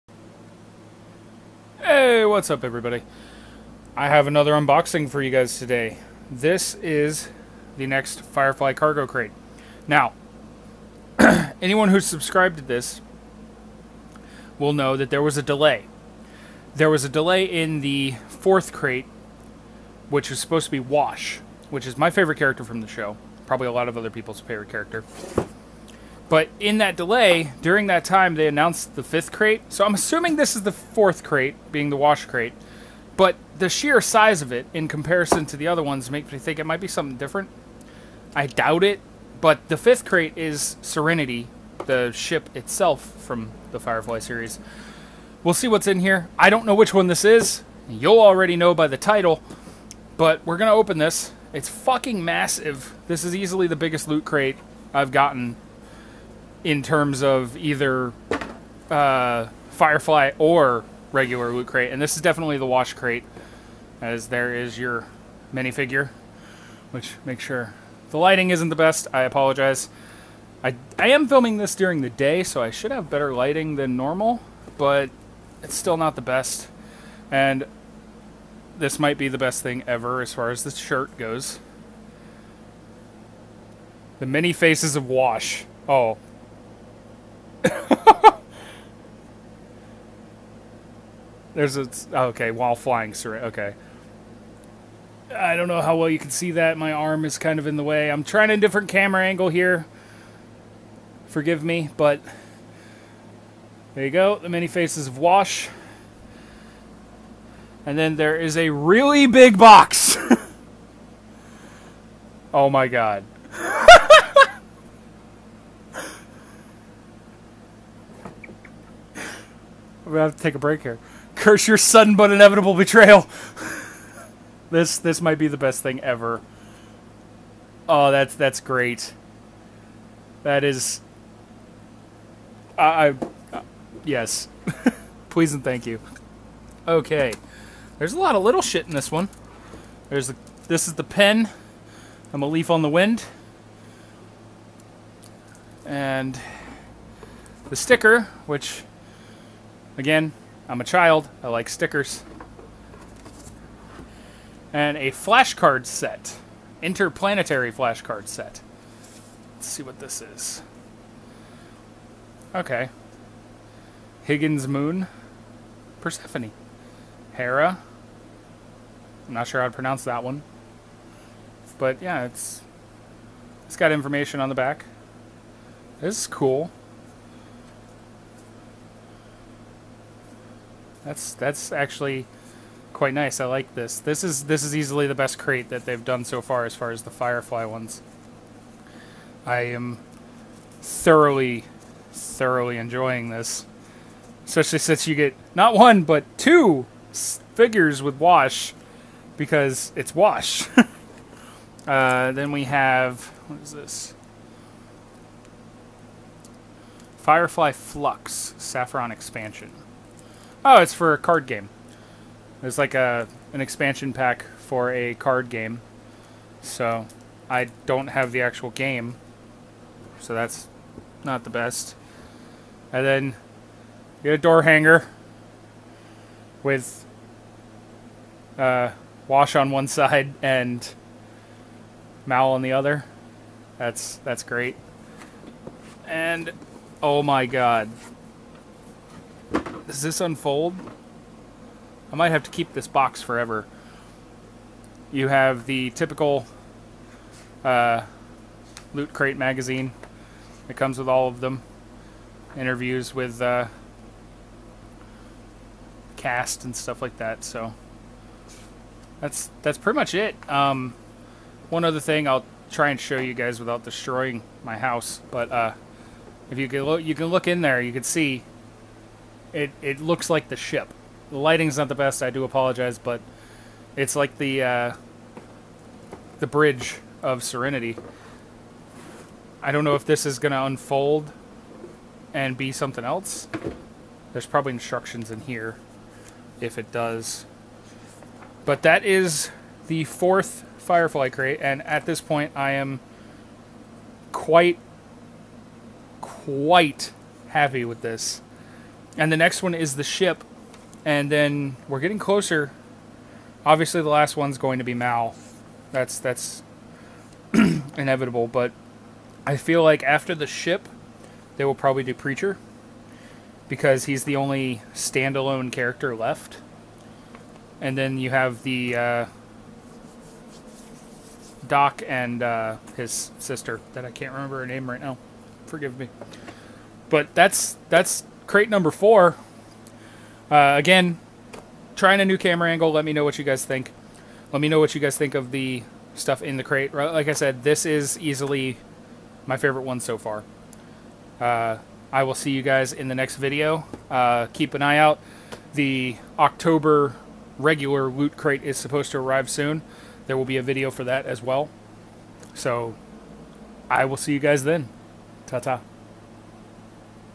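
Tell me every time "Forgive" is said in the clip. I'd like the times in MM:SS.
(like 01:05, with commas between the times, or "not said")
01:41, 05:25.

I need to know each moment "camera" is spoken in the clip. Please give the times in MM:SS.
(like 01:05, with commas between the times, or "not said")
01:38, 05:32.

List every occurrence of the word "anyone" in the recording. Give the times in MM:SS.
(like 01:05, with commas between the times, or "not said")
00:11.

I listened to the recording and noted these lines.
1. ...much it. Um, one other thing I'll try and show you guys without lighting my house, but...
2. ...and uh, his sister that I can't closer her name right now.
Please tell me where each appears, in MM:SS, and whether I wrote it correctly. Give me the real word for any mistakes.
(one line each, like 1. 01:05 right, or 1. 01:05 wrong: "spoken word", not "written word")
1. 04:19 wrong: "destroying", not "lighting"
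2. 05:22 wrong: "remember", not "closer".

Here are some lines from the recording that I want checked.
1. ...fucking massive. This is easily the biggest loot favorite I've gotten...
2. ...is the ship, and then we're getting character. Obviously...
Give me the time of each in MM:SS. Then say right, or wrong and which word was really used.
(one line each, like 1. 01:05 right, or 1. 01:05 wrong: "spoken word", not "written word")
1. 00:51 wrong: "crate", not "favorite"
2. 04:59 wrong: "closer", not "character".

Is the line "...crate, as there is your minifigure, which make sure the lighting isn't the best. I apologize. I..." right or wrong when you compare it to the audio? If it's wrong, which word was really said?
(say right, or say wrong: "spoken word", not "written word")
right.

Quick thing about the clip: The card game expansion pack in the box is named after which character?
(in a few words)
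Saffron.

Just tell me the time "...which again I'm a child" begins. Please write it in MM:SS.
02:28.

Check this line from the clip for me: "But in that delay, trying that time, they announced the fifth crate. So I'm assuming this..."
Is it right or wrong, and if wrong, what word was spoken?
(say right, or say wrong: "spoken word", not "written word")
wrong: "during", not "trying".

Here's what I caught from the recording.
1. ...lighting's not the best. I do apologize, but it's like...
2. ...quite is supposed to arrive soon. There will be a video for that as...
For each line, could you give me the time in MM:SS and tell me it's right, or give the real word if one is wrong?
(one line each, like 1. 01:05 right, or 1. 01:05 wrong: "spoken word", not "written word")
1. 04:31 right
2. 05:48 wrong: "crate", not "quite".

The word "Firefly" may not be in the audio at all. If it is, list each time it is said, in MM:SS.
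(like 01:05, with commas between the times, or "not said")
00:08, 00:43, 00:59, 03:07, 03:27, 04:50.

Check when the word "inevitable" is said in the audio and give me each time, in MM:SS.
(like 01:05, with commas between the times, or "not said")
02:02, 05:07.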